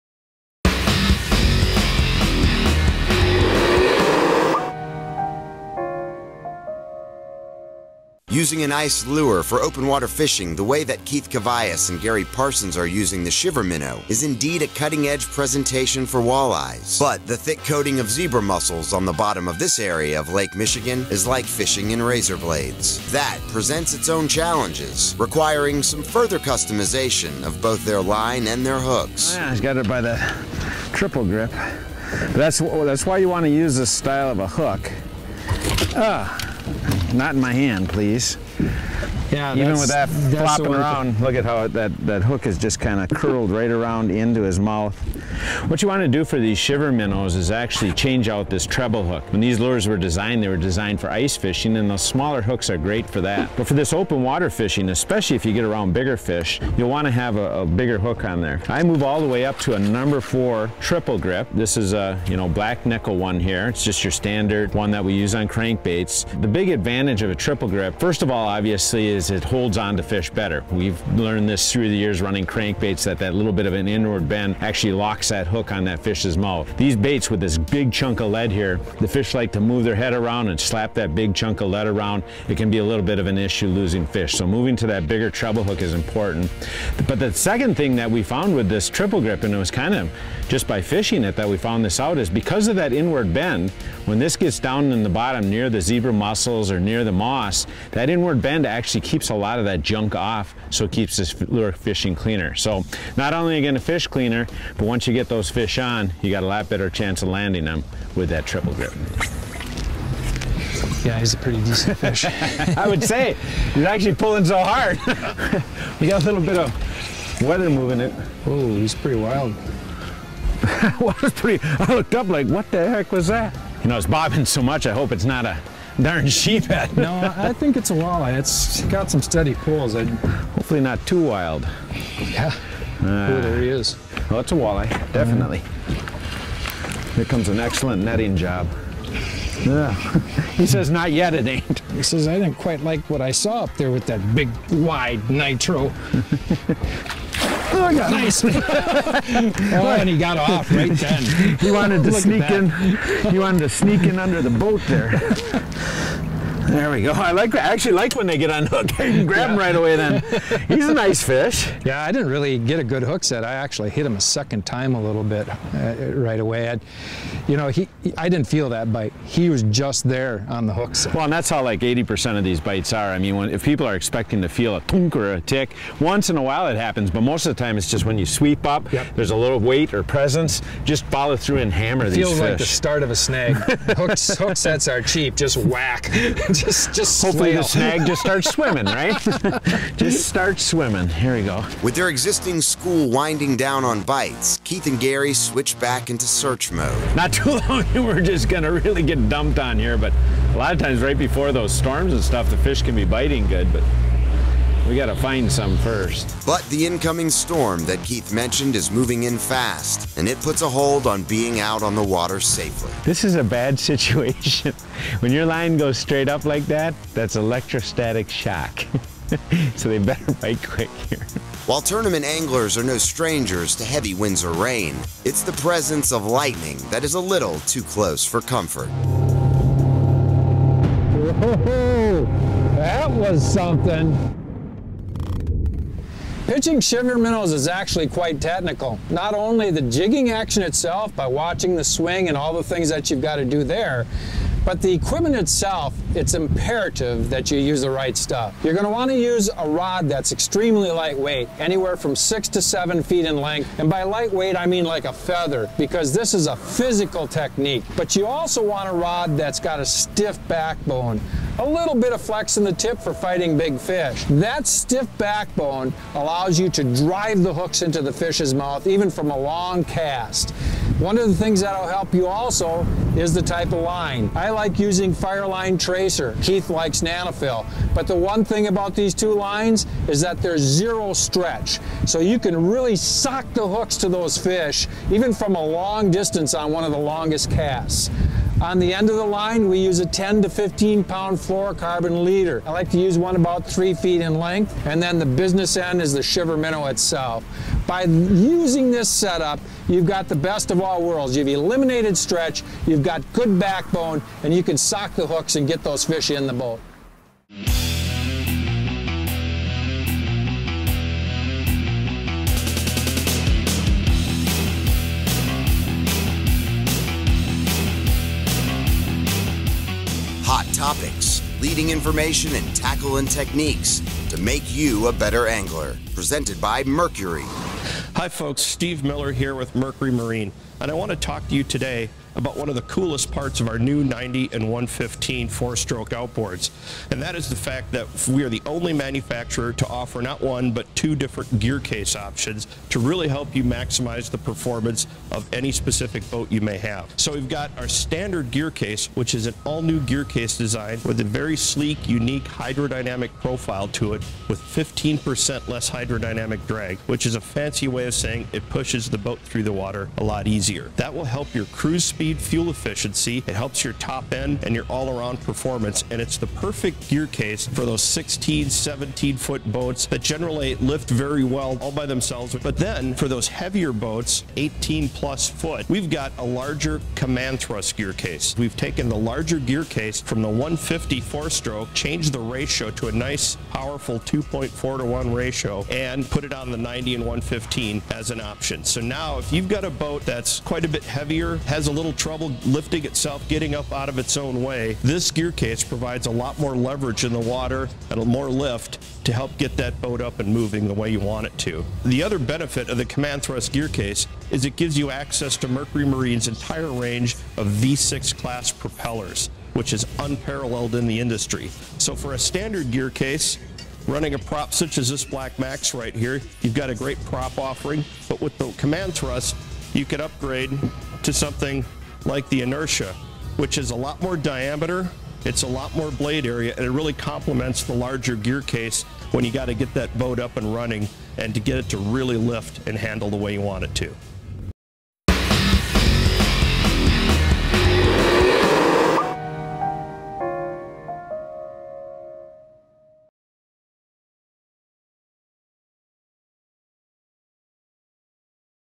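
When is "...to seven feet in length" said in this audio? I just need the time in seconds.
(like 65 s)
252 s.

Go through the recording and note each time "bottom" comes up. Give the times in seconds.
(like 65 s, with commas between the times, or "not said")
19 s, 95 s.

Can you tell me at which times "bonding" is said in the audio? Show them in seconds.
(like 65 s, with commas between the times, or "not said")
not said.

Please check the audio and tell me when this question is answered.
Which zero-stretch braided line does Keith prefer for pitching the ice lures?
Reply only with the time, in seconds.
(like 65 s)
277 s.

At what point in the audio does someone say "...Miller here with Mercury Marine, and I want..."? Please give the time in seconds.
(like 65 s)
329 s.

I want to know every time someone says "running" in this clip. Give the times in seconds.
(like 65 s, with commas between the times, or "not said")
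72 s, 414 s, 430 s.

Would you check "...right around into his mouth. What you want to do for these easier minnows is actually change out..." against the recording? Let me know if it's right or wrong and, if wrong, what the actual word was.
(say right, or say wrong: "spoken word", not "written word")
wrong: "shiver", not "easier".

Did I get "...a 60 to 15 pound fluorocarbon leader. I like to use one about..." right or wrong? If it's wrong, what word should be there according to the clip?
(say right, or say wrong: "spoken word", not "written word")
wrong: "10", not "60".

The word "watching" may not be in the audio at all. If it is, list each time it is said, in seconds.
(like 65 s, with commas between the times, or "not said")
241 s.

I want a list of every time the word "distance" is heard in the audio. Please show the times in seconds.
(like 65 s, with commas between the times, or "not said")
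286 s.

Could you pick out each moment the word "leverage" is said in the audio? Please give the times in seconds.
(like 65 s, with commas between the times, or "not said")
396 s.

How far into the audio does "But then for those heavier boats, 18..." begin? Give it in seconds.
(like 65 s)
372 s.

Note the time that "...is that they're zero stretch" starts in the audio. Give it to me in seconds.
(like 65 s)
280 s.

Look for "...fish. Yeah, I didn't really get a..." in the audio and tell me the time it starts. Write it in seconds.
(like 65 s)
161 s.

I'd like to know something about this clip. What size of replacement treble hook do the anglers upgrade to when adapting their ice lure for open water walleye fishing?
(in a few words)
number 4.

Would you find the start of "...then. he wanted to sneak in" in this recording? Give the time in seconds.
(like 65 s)
150 s.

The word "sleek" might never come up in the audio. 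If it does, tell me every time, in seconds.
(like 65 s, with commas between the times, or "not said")
351 s.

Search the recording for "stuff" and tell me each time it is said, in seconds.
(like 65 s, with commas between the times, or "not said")
202 s, 248 s.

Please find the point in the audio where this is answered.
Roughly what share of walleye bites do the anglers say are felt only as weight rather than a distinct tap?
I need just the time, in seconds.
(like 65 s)
171 s.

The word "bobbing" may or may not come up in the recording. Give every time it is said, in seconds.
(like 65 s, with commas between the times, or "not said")
124 s.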